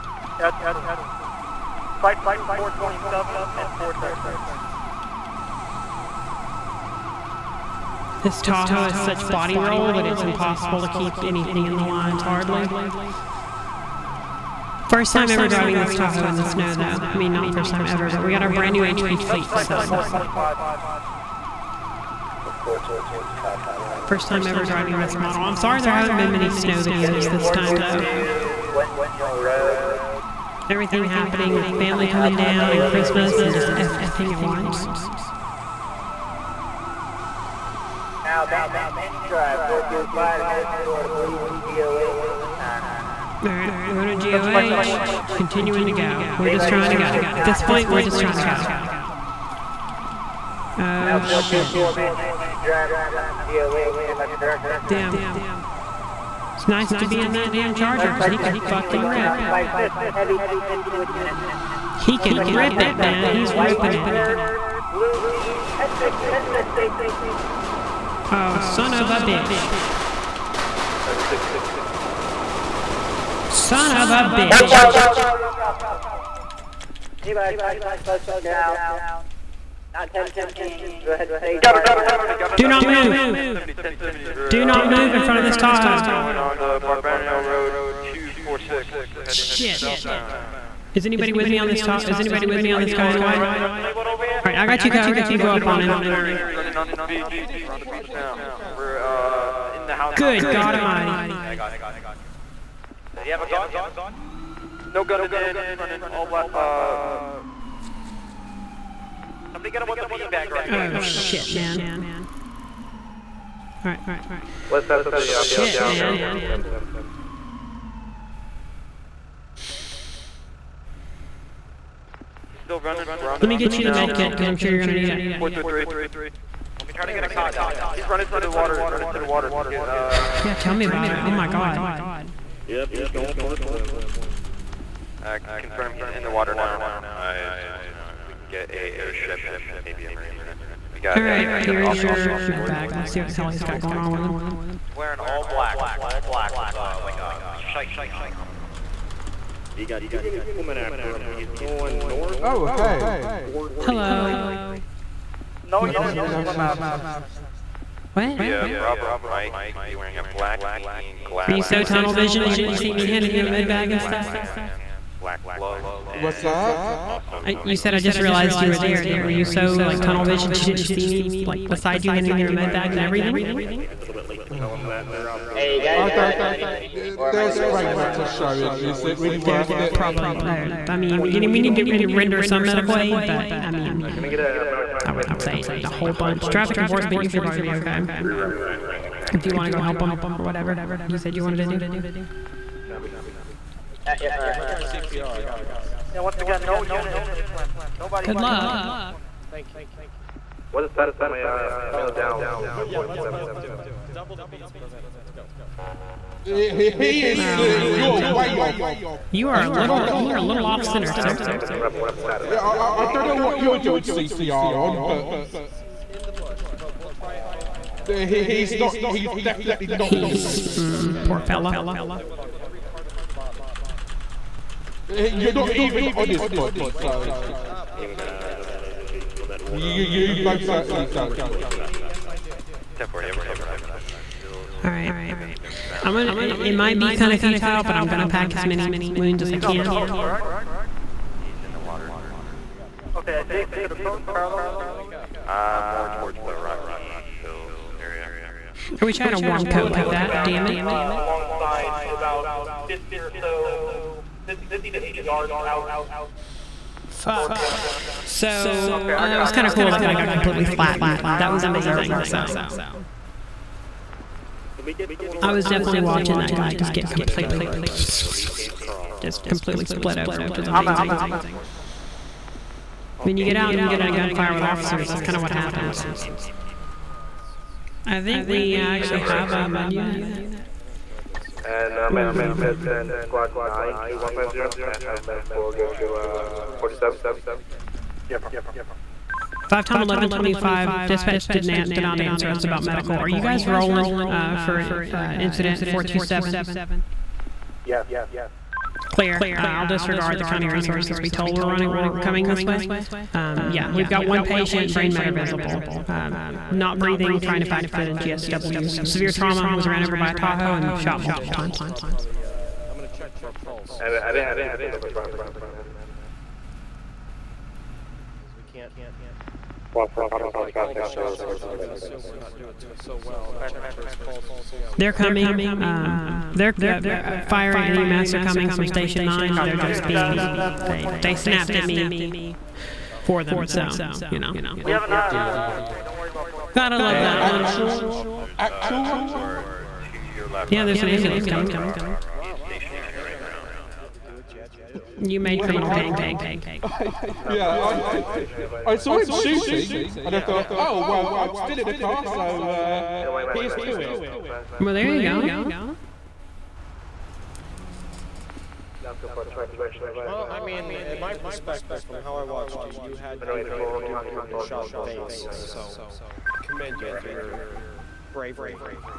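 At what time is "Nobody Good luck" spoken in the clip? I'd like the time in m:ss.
3:17.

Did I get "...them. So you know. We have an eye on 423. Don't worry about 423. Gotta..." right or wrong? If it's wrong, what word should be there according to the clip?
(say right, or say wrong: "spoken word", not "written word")
right.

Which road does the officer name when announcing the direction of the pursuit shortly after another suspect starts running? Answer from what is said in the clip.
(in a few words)
Barbareno Road 246.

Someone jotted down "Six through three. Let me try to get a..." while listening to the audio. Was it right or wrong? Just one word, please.
wrong.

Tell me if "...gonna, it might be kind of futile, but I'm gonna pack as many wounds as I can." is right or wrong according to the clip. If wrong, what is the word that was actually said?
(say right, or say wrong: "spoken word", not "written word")
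right.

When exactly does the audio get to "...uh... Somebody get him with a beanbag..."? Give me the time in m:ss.
1:46.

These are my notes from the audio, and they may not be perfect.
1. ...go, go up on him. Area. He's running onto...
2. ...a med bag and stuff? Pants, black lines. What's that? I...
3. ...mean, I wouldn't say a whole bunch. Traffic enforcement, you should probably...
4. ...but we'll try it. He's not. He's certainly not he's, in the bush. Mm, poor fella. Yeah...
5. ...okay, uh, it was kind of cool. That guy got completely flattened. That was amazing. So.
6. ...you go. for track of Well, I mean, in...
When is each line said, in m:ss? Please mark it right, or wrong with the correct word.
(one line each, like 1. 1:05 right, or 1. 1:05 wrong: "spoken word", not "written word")
1. 1:35 right
2. 2:43 wrong: "gloves", not "lines"
3. 3:03 right
4. 3:36 wrong: "definitely", not "certainly"
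5. 4:18 right
6. 5:55 right.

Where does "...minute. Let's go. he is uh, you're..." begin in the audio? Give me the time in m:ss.
3:24.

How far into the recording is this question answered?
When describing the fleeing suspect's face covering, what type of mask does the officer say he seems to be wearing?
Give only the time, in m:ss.
2:27.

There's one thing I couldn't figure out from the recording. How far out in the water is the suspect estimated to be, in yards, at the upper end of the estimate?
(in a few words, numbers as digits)
80 yards.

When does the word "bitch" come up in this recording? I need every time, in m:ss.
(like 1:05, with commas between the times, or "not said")
1:09, 1:14.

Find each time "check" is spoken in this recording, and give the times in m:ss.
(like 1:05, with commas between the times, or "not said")
5:13, 5:23.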